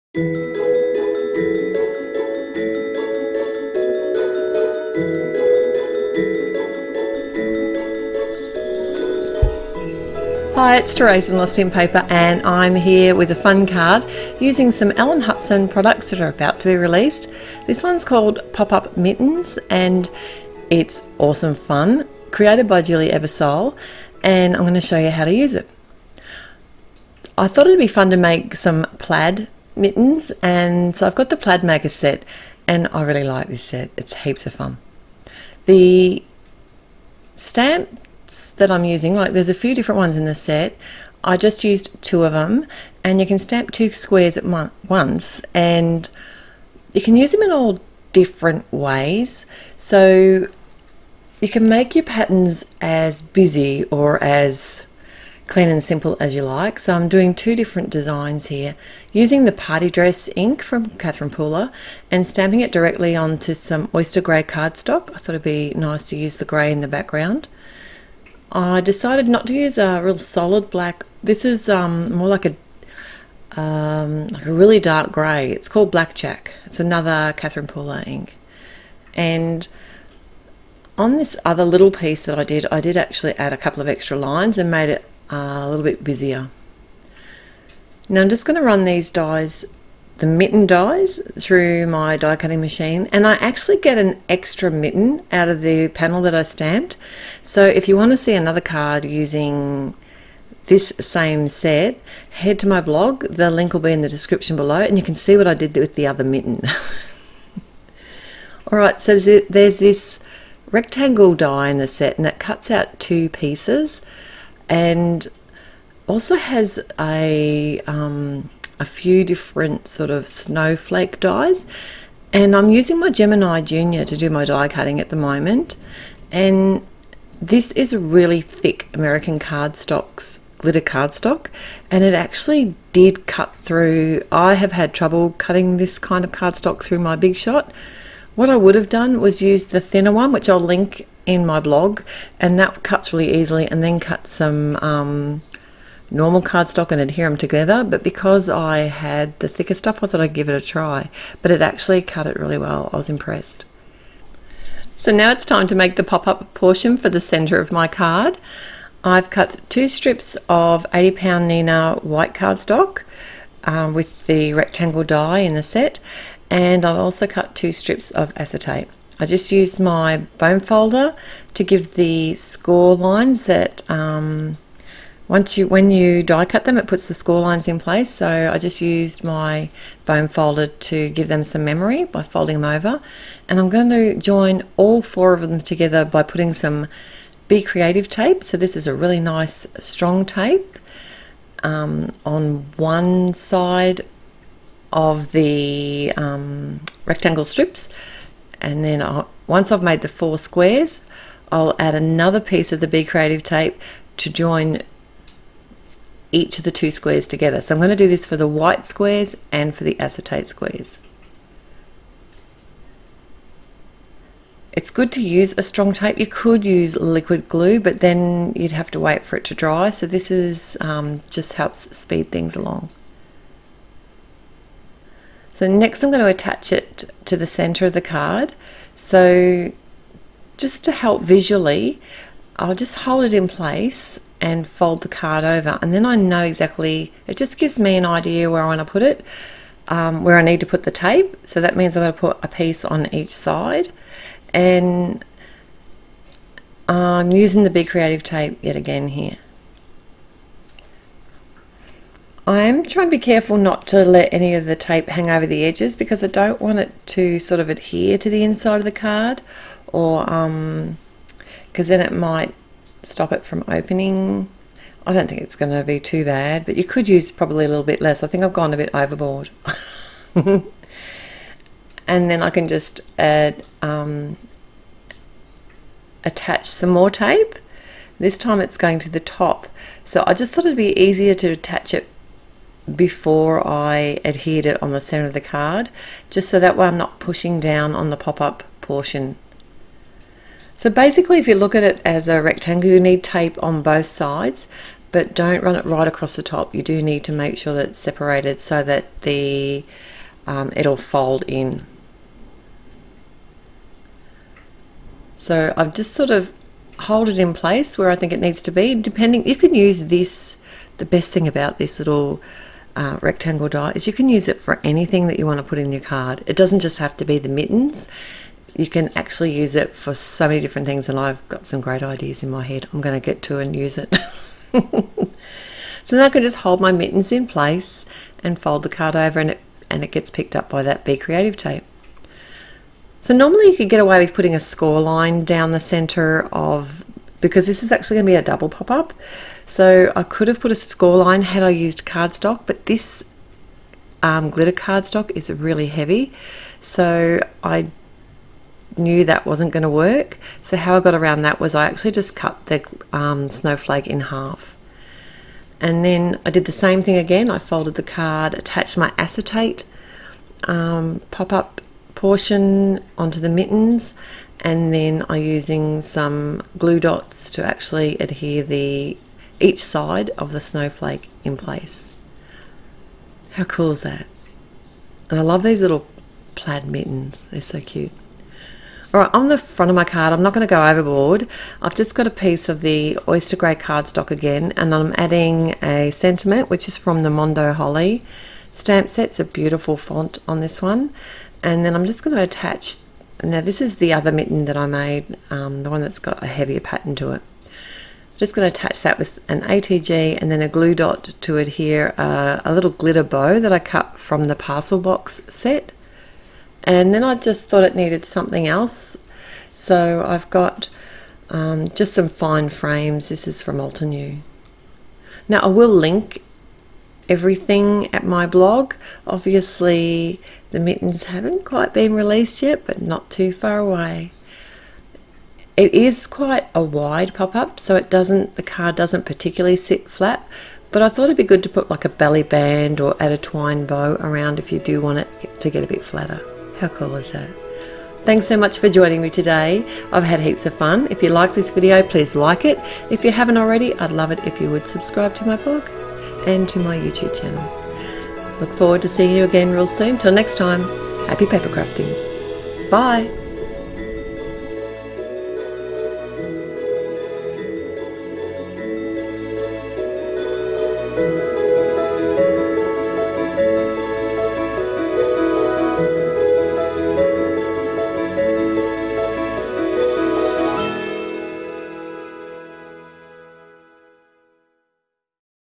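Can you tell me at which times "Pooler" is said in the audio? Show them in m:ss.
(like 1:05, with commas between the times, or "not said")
1:01, 1:17.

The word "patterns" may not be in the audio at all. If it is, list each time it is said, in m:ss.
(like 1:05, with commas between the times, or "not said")
0:52, 6:36.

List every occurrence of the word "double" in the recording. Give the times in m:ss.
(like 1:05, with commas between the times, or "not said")
5:38.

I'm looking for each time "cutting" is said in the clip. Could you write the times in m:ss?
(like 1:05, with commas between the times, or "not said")
1:32, 2:04, 2:15.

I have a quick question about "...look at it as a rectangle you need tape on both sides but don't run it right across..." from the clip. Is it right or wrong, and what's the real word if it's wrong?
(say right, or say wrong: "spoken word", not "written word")
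right.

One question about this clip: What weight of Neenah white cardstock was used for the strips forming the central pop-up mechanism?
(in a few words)
80 pound.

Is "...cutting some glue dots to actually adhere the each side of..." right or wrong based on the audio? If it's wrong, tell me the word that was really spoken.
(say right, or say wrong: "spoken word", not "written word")
wrong: "using", not "cutting".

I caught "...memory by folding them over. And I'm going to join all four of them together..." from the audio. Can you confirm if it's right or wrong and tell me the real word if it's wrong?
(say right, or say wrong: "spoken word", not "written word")
right.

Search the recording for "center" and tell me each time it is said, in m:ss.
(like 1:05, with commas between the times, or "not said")
2:37, 3:47, 4:45, 5:35.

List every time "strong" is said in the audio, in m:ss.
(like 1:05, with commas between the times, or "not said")
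3:09, 3:35.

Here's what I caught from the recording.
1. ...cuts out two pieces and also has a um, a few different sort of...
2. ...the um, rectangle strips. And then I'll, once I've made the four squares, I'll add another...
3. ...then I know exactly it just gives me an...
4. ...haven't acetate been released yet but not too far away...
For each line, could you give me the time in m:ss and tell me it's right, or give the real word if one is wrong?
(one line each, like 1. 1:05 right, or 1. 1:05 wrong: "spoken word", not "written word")
1. 1:52 right
2. 3:15 right
3. 3:55 right
4. 7:01 wrong: "quite", not "acetate".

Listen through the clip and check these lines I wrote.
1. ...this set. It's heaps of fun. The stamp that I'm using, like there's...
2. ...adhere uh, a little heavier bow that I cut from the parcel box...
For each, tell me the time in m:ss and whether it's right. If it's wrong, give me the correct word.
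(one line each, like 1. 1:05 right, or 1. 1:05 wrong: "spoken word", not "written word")
1. 0:33 right
2. 6:41 wrong: "glitter", not "heavier".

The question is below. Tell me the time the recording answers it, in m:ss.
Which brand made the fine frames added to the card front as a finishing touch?
6:53.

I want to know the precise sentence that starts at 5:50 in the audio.
So how I got around that was I actually just cut the um, snowflake in half.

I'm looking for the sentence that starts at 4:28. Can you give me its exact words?
I think I've gone a bit overboard.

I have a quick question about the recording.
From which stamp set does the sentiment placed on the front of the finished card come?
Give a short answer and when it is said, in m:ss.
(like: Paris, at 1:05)
Mondo Holly, at 6:27.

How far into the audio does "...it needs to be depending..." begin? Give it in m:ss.
5:08.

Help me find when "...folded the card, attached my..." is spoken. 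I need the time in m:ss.
5:57.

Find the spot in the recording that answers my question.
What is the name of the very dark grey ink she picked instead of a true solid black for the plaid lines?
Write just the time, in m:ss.
1:15.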